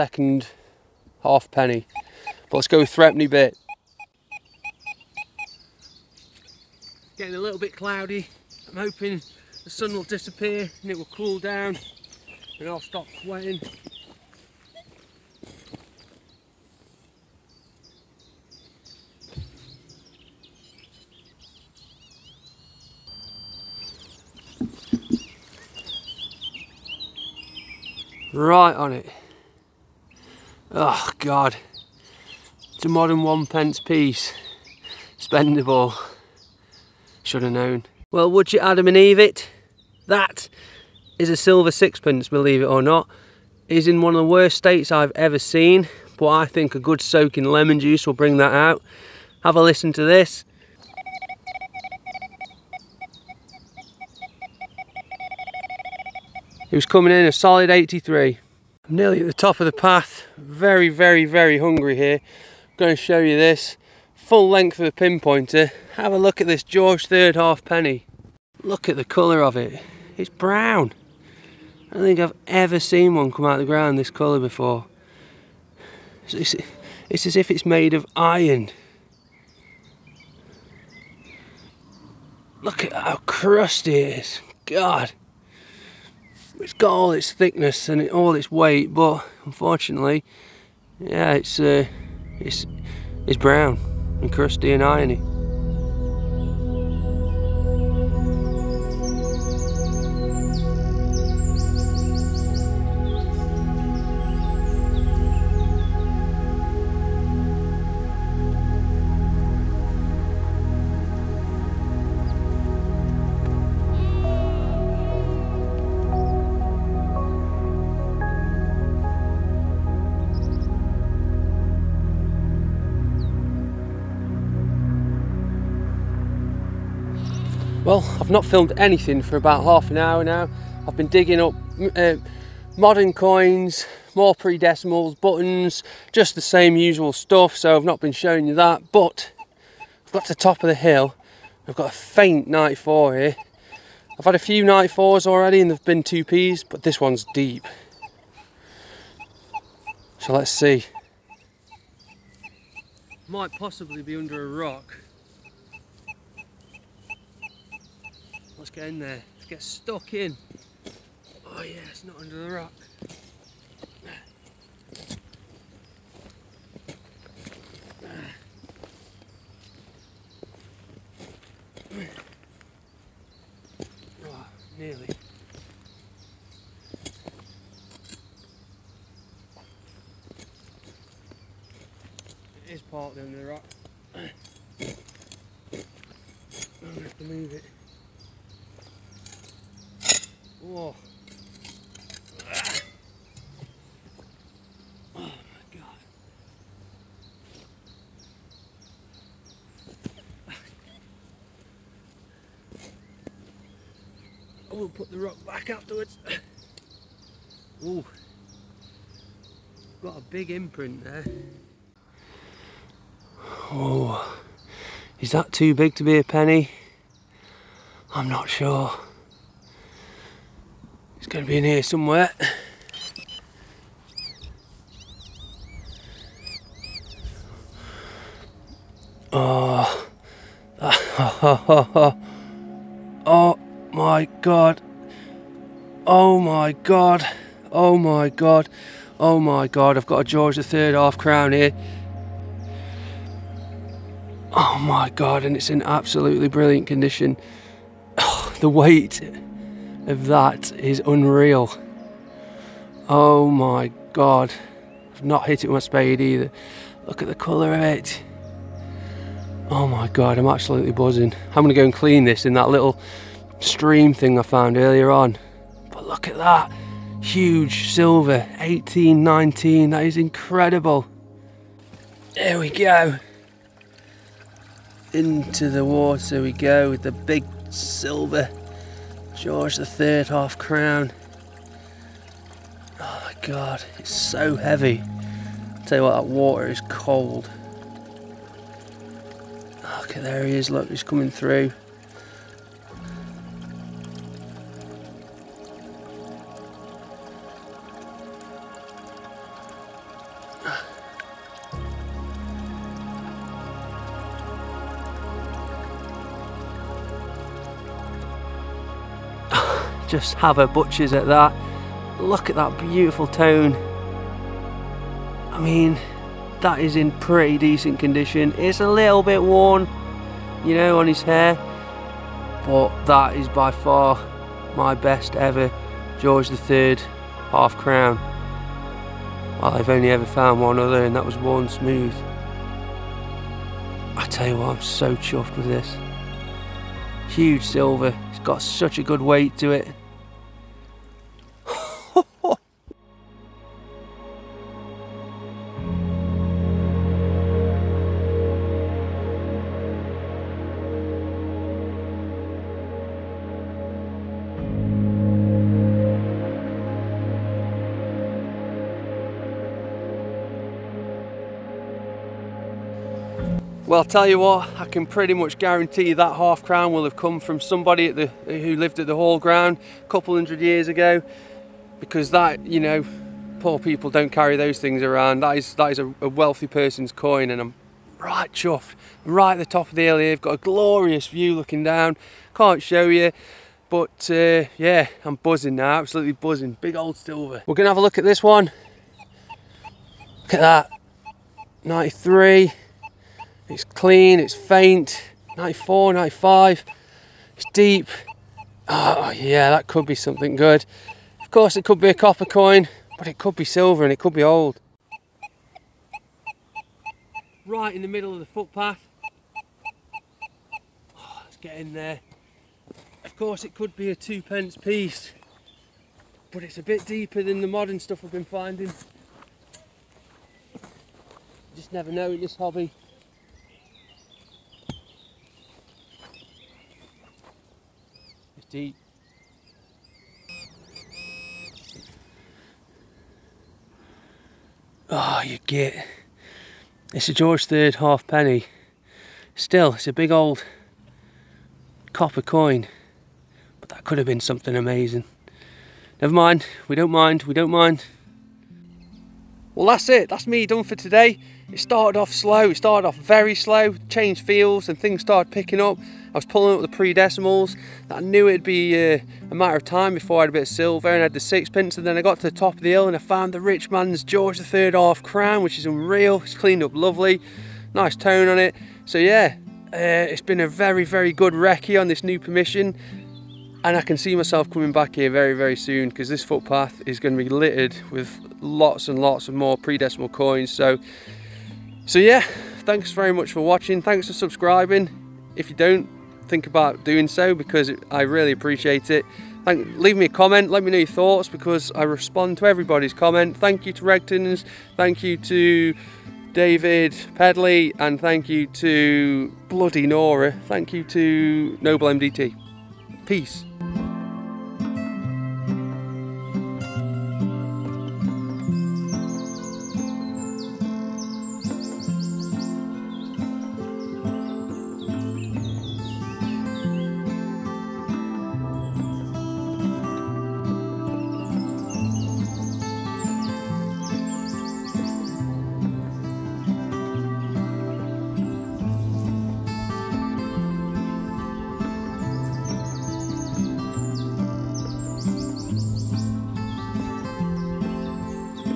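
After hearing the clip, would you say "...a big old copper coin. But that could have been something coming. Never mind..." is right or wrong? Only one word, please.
wrong.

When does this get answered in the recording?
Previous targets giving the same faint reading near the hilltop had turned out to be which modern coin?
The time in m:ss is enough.
2:26.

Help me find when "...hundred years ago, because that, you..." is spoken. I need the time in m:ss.
6:10.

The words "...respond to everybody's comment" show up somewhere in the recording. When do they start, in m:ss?
8:12.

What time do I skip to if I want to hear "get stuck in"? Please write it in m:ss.
2:39.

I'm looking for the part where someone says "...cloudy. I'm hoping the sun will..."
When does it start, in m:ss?
0:07.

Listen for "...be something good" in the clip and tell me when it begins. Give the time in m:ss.
6:40.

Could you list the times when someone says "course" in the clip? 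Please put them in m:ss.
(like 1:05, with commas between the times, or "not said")
6:41, 6:53.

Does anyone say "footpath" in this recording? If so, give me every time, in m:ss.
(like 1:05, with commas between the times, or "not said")
6:48, 7:56.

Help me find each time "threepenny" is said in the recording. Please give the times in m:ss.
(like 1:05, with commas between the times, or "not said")
0:02.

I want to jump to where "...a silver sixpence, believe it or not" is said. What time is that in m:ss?
0:41.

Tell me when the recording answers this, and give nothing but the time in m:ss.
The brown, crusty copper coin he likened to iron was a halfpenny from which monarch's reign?
1:06.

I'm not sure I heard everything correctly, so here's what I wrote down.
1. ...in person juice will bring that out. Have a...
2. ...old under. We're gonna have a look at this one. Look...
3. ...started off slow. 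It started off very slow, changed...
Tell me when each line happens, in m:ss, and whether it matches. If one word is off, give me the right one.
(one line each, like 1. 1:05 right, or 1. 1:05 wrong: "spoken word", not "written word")
1. 0:47 wrong: "lemon", not "person"
2. 6:26 wrong: "silver", not "under"
3. 7:31 right.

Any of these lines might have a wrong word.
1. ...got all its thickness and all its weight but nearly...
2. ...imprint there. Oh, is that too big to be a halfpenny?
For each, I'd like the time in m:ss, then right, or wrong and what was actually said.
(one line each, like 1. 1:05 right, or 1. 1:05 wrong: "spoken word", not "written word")
1. 1:26 wrong: "unfortunately", not "nearly"
2. 3:30 wrong: "penny", not "halfpenny".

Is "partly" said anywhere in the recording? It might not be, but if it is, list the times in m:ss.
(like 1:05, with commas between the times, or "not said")
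3:02.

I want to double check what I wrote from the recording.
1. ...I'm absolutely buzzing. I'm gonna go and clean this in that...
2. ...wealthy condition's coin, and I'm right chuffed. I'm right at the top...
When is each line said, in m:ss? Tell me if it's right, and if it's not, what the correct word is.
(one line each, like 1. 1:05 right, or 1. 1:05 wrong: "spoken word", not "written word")
1. 4:20 right
2. 6:16 wrong: "person", not "condition".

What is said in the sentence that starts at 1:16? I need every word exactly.
it's, it's as if it's made of iron.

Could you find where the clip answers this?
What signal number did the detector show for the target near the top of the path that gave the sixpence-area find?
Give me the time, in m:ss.
0:57.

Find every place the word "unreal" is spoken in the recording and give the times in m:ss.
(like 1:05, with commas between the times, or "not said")
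4:11, 7:45.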